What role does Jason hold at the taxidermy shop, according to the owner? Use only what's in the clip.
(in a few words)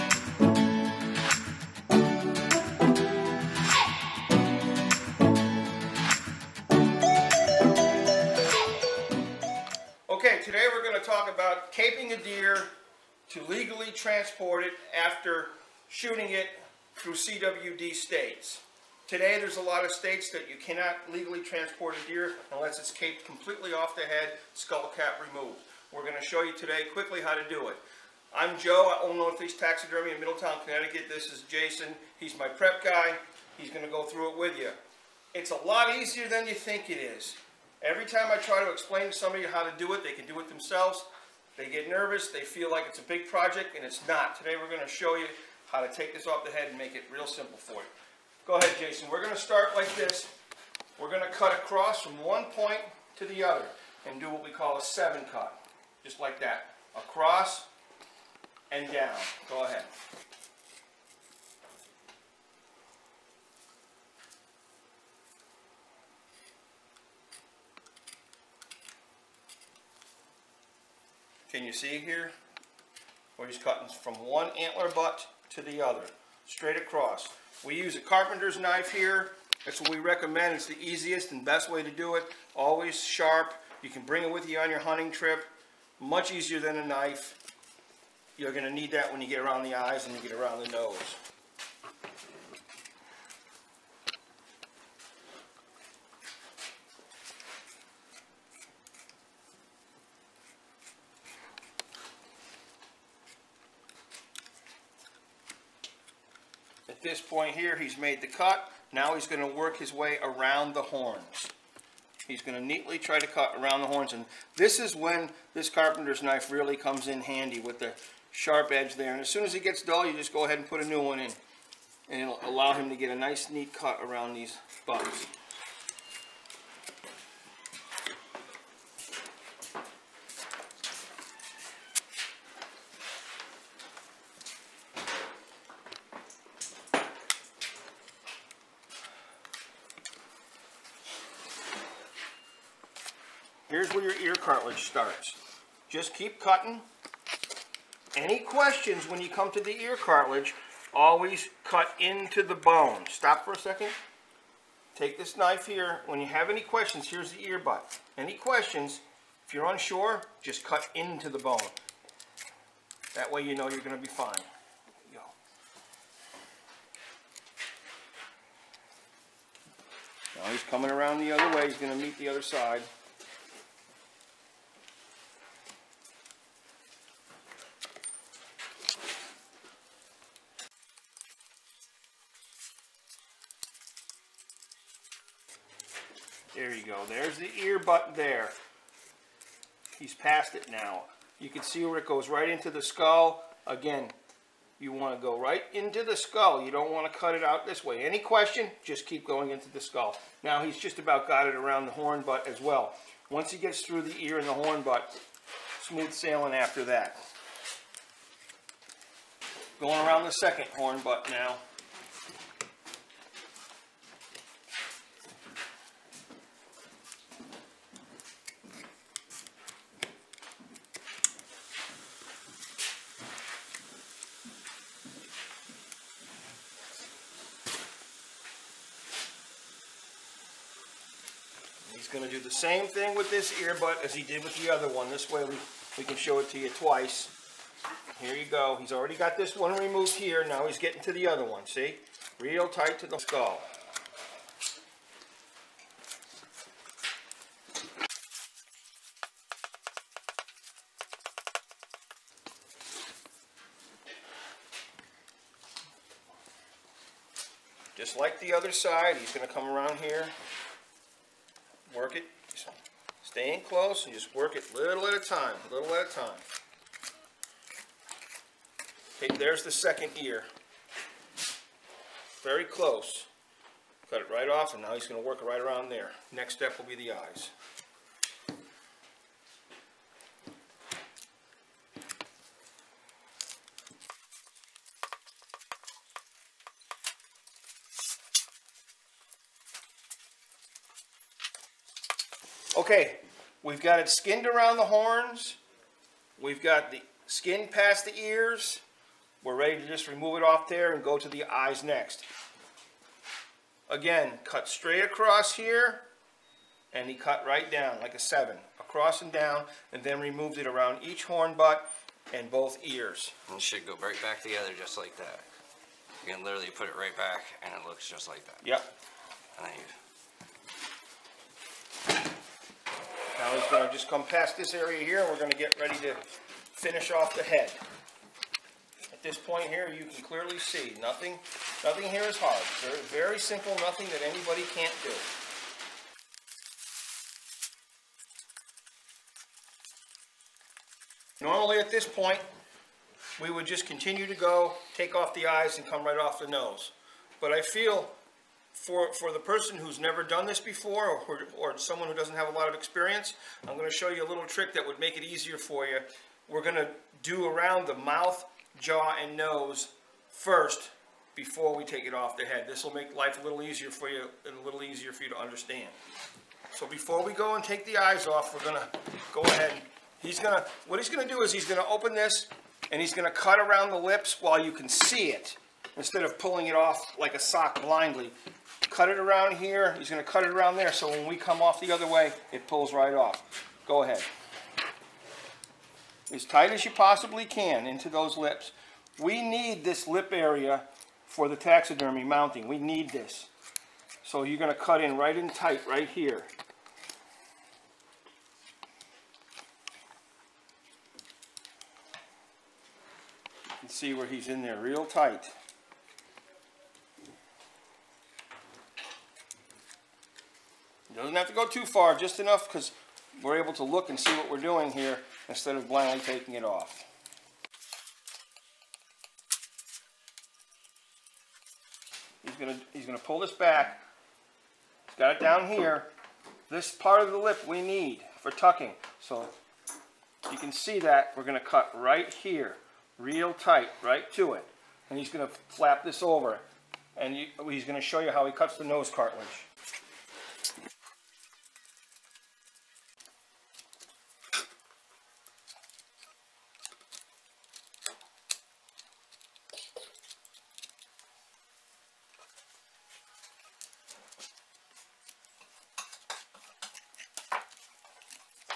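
prep guy.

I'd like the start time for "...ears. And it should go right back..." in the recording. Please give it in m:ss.
5:12.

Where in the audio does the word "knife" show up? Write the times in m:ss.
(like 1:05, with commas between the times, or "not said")
1:18, 1:26, 1:56, 2:35.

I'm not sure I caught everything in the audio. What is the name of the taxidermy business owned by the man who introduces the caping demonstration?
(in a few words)
Northeast Taxidermy.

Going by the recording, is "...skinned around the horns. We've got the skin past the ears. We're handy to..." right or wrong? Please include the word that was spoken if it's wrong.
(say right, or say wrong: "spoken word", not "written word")
wrong: "ready", not "handy".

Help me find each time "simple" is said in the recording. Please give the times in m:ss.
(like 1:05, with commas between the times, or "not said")
0:47, 5:33.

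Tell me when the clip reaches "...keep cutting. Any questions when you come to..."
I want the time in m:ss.
2:26.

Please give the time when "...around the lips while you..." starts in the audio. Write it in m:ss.
6:13.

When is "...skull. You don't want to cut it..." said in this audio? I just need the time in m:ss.
3:16.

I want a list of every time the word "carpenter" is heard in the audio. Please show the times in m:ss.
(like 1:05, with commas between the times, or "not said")
1:18, 1:55.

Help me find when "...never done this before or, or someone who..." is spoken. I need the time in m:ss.
5:49.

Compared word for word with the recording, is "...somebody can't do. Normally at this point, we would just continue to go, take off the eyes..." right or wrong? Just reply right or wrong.
wrong.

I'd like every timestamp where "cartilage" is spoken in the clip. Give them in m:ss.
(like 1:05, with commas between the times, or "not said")
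2:24, 2:29, 7:19.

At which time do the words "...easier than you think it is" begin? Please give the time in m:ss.
0:35.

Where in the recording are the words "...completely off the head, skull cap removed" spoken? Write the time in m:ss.
0:23.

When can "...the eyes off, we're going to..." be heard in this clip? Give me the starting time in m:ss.
6:07.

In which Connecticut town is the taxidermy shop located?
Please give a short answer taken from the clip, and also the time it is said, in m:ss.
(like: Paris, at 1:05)
Middletown, at 0:30.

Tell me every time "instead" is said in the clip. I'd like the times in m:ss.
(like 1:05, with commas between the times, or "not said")
6:15, 6:55.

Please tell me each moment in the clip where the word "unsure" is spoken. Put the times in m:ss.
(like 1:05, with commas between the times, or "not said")
2:39.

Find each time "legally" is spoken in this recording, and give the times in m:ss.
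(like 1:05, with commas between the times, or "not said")
0:13, 0:21.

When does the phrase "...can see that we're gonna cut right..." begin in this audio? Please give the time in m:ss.
7:10.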